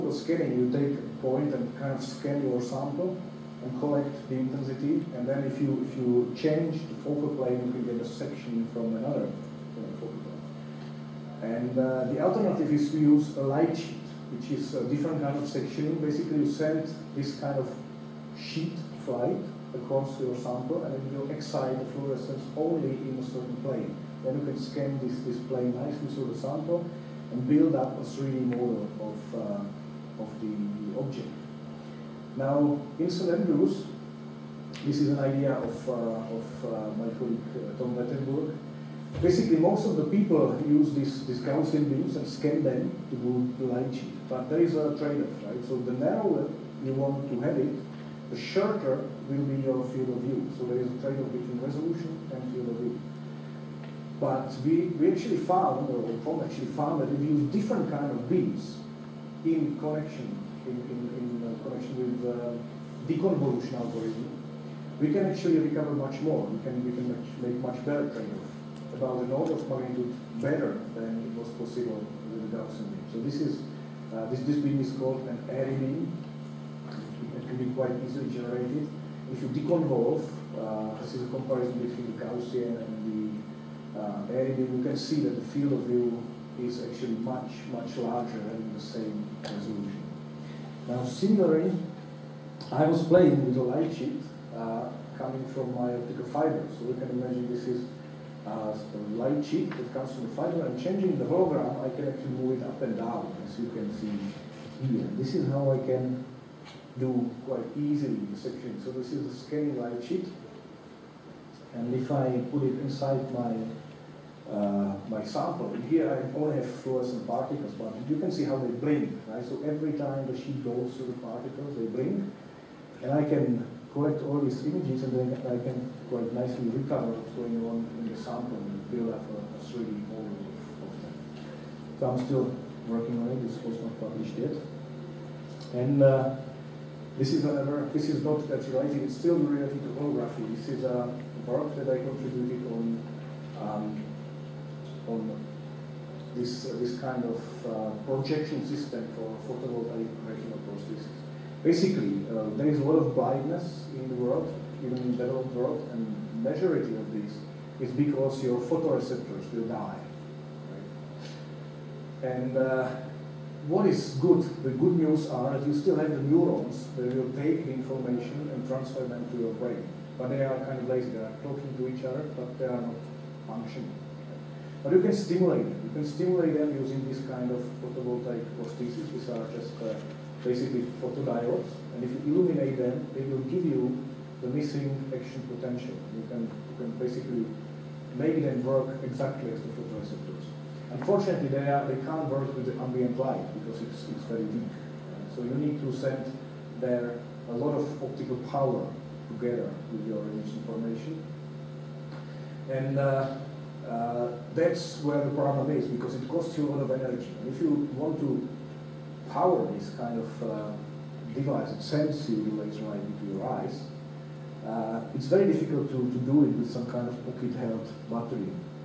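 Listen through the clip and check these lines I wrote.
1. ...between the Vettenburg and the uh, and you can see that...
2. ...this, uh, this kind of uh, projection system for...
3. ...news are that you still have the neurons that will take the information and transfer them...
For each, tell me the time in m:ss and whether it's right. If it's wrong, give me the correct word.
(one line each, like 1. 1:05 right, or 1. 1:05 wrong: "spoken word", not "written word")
1. 1:21 wrong: "Gaussian", not "Vettenburg"
2. 2:26 right
3. 2:44 right.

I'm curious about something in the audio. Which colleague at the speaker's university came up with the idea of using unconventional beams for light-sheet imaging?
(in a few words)
Tom Vettenburg.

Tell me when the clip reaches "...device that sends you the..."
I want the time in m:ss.
3:31.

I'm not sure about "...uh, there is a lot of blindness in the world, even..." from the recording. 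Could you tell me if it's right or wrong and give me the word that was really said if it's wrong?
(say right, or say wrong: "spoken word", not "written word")
right.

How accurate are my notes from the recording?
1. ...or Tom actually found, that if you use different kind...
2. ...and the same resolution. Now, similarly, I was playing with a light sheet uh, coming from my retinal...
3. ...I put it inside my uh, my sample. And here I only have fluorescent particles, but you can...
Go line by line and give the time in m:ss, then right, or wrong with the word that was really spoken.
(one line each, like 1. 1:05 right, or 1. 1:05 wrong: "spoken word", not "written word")
1. 0:55 right
2. 1:28 wrong: "optical", not "retinal"
3. 1:52 right.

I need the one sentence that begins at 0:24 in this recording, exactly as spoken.
Then you can scan this, this plane nicely through the sample, and build up a 3D model of, uh, of the object.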